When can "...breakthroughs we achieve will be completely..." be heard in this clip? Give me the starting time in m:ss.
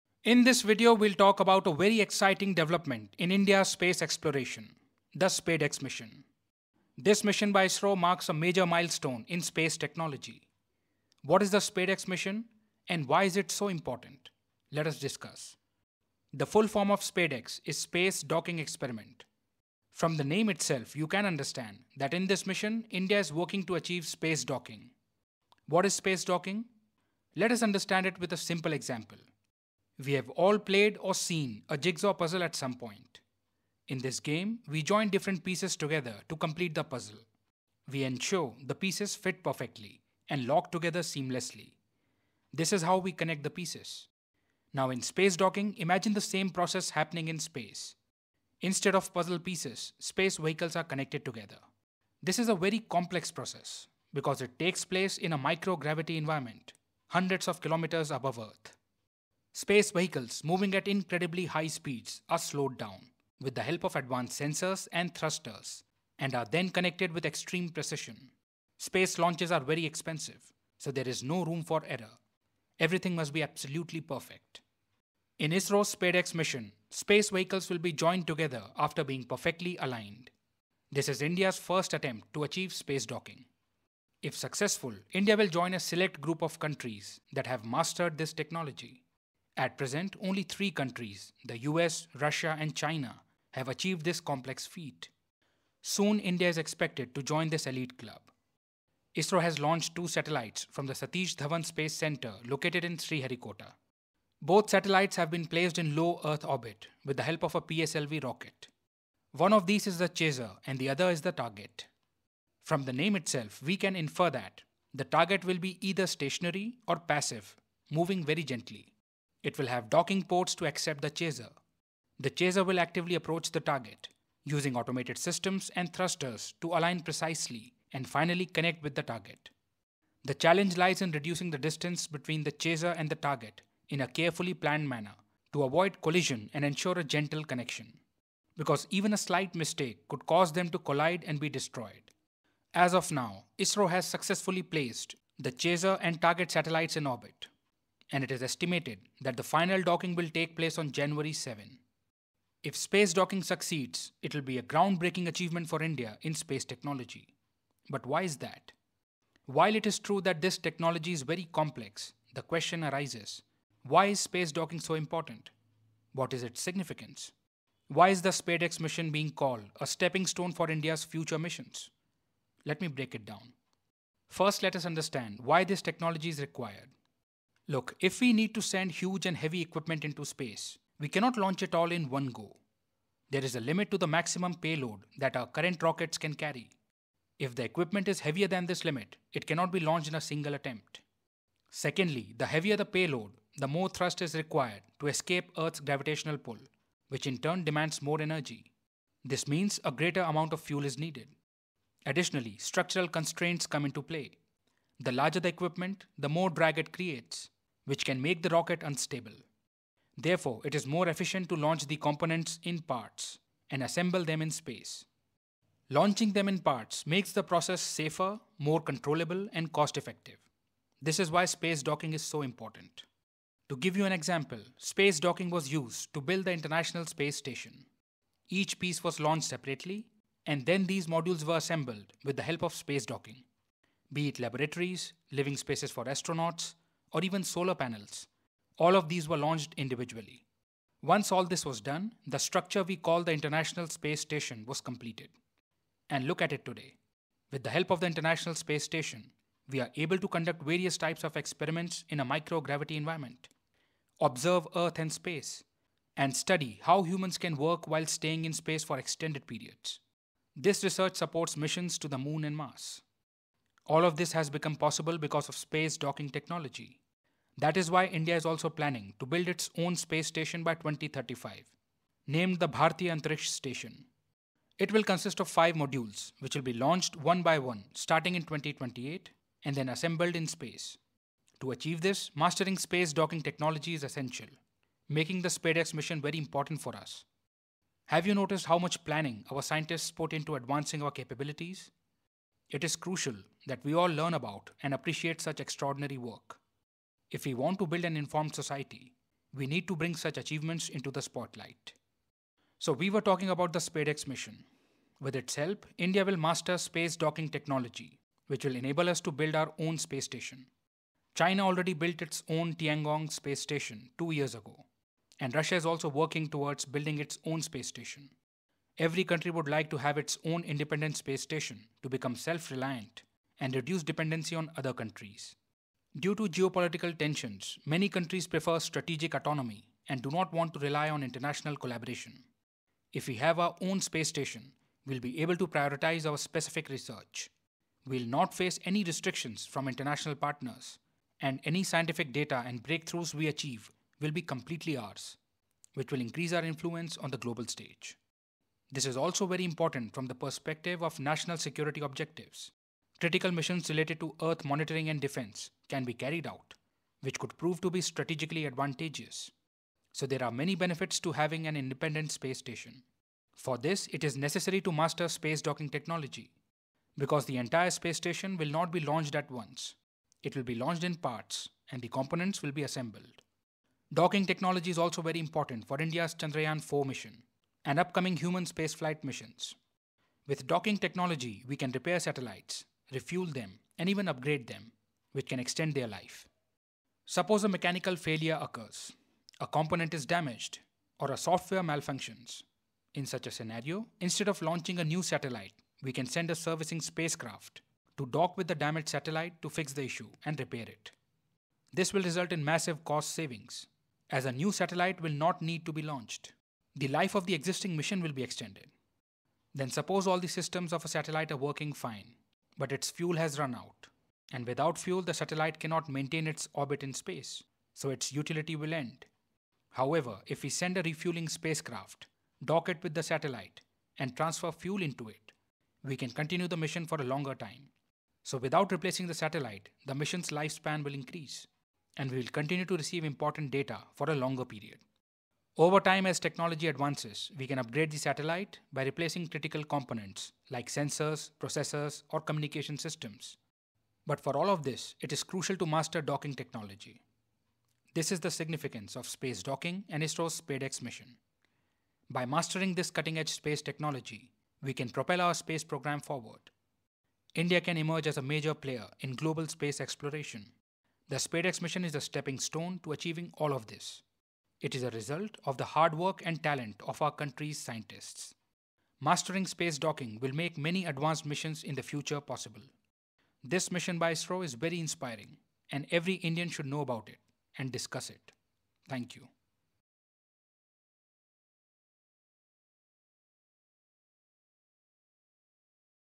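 5:42.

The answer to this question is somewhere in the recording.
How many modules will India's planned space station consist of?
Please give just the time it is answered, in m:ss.
4:35.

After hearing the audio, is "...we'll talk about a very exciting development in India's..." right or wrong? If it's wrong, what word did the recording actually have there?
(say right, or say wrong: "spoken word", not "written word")
right.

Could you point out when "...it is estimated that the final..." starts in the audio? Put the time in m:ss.
2:28.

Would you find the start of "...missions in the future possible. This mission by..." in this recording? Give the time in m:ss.
7:51.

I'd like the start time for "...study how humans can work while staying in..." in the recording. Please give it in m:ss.
4:16.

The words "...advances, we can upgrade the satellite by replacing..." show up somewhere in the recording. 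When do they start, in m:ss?
7:16.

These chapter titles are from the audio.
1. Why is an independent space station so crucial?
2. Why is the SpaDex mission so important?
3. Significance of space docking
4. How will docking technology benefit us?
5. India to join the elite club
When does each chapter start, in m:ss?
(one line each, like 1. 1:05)
1. 5:02
2. 3:42
3. 2:31
4. 6:26
5. 1:14.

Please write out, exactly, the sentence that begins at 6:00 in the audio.
So there are many benefits to having an independent space station.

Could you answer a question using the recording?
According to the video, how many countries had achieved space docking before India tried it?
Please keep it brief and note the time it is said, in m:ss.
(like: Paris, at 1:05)
3, at 1:30.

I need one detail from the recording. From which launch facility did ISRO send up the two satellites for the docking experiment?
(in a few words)
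Satish Dhawan Space Center.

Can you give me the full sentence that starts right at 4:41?
To achieve this, mastering space docking technology is essential, making the Spadex mission very important for us.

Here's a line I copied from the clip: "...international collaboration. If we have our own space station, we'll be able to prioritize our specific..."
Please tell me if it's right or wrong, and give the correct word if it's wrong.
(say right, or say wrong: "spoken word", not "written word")
right.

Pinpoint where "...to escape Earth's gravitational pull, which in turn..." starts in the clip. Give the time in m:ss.
3:14.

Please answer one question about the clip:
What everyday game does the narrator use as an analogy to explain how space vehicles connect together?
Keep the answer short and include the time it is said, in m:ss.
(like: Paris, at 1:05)
Jigsaw puzzle, at 0:31.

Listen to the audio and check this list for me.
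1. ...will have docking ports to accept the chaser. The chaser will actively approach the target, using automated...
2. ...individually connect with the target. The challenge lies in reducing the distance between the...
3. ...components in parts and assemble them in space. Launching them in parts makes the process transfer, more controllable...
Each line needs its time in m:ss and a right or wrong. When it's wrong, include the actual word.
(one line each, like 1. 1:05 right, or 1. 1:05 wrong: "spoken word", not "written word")
1. 1:59 right
2. 2:08 wrong: "finally", not "individually"
3. 3:31 wrong: "safer", not "transfer".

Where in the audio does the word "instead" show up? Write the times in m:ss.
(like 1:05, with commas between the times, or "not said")
0:48, 6:34.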